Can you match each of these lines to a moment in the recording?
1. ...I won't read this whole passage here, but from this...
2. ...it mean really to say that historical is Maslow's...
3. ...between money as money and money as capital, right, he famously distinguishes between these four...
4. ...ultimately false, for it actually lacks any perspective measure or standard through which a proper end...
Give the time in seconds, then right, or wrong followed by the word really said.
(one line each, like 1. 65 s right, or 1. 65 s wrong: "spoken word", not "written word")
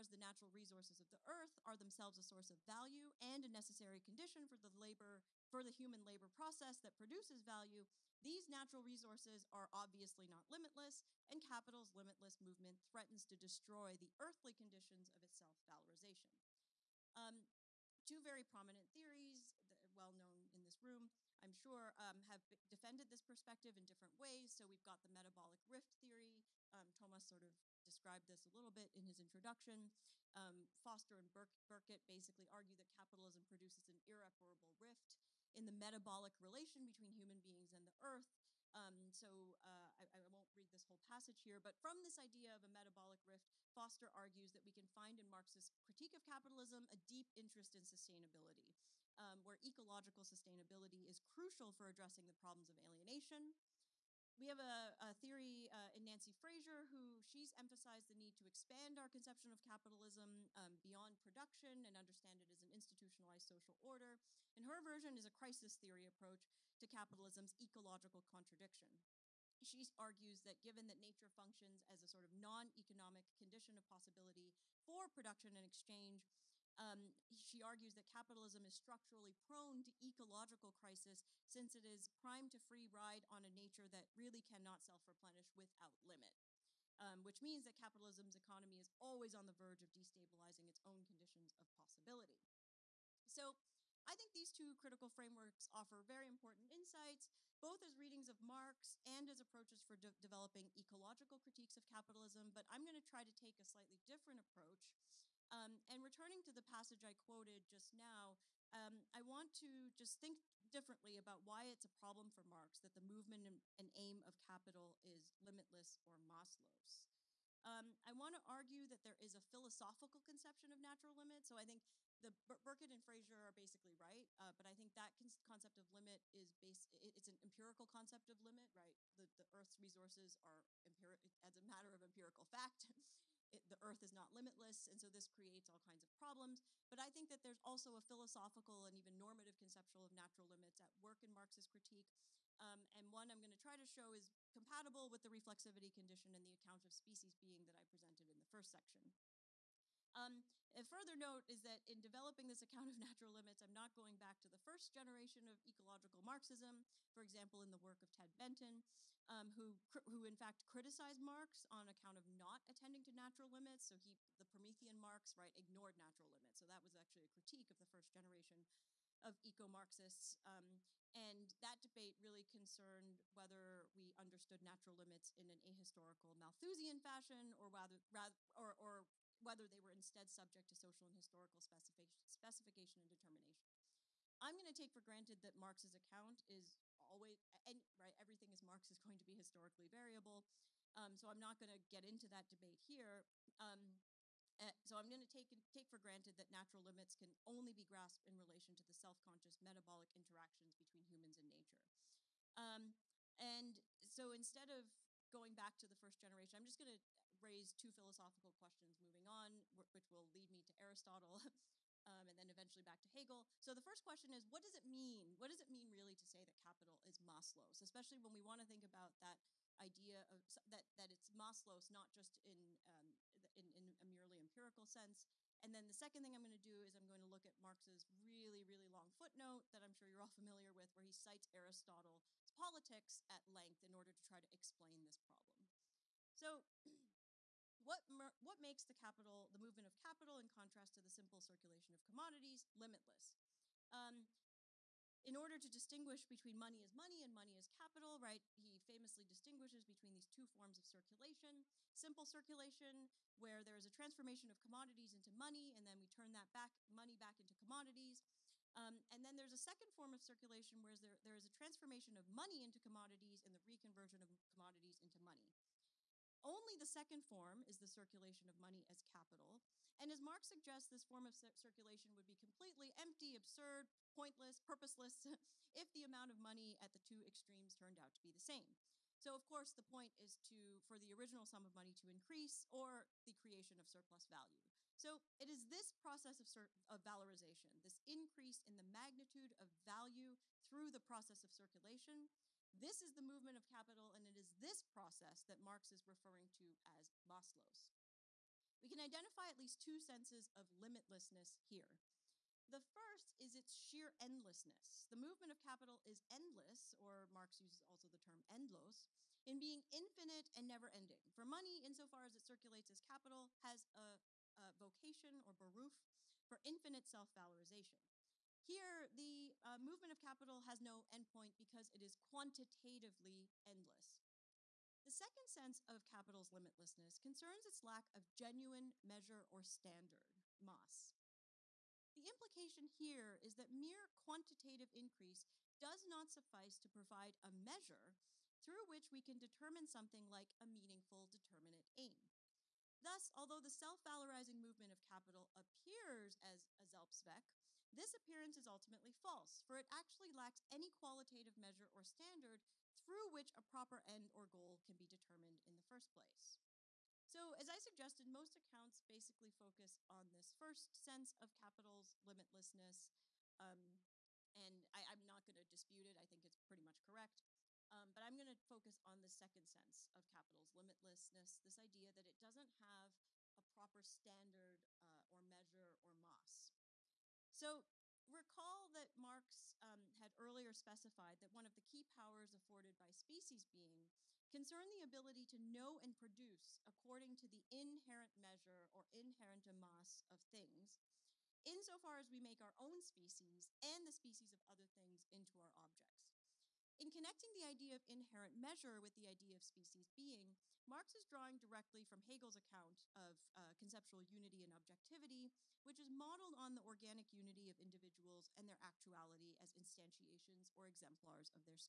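1. 40 s right
2. 215 s wrong: "capital", not "historical"
3. 246 s wrong: "two", not "four"
4. 348 s wrong: "qualitative", not "perspective".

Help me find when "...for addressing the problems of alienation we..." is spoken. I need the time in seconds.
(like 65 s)
51 s.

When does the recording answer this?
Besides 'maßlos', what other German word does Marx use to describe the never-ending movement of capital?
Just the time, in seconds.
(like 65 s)
308 s.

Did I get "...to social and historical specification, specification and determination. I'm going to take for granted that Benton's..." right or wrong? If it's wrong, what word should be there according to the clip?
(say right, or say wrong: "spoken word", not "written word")
wrong: "Marx", not "Benton".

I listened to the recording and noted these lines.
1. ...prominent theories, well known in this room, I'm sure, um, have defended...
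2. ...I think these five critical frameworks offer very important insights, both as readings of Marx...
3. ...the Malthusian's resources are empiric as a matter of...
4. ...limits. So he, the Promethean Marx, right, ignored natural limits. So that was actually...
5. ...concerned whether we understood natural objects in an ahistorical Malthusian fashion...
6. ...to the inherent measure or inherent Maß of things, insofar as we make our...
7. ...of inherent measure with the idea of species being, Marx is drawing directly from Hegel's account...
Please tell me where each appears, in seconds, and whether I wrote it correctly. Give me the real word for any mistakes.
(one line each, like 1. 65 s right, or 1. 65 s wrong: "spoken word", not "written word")
1. 18 s right
2. 94 s wrong: "two", not "five"
3. 129 s wrong: "Earth", not "Malthusian"
4. 163 s right
5. 172 s wrong: "limits", not "objects"
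6. 387 s right
7. 397 s right.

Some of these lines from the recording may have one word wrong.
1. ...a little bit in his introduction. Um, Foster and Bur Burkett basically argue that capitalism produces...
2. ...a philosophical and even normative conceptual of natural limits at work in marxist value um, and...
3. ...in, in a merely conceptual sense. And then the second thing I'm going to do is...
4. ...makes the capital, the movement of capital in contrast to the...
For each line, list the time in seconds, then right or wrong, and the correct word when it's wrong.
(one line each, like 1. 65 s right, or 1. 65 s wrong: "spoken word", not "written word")
1. 28 s right
2. 137 s wrong: "critique", not "value"
3. 223 s wrong: "empirical", not "conceptual"
4. 238 s right.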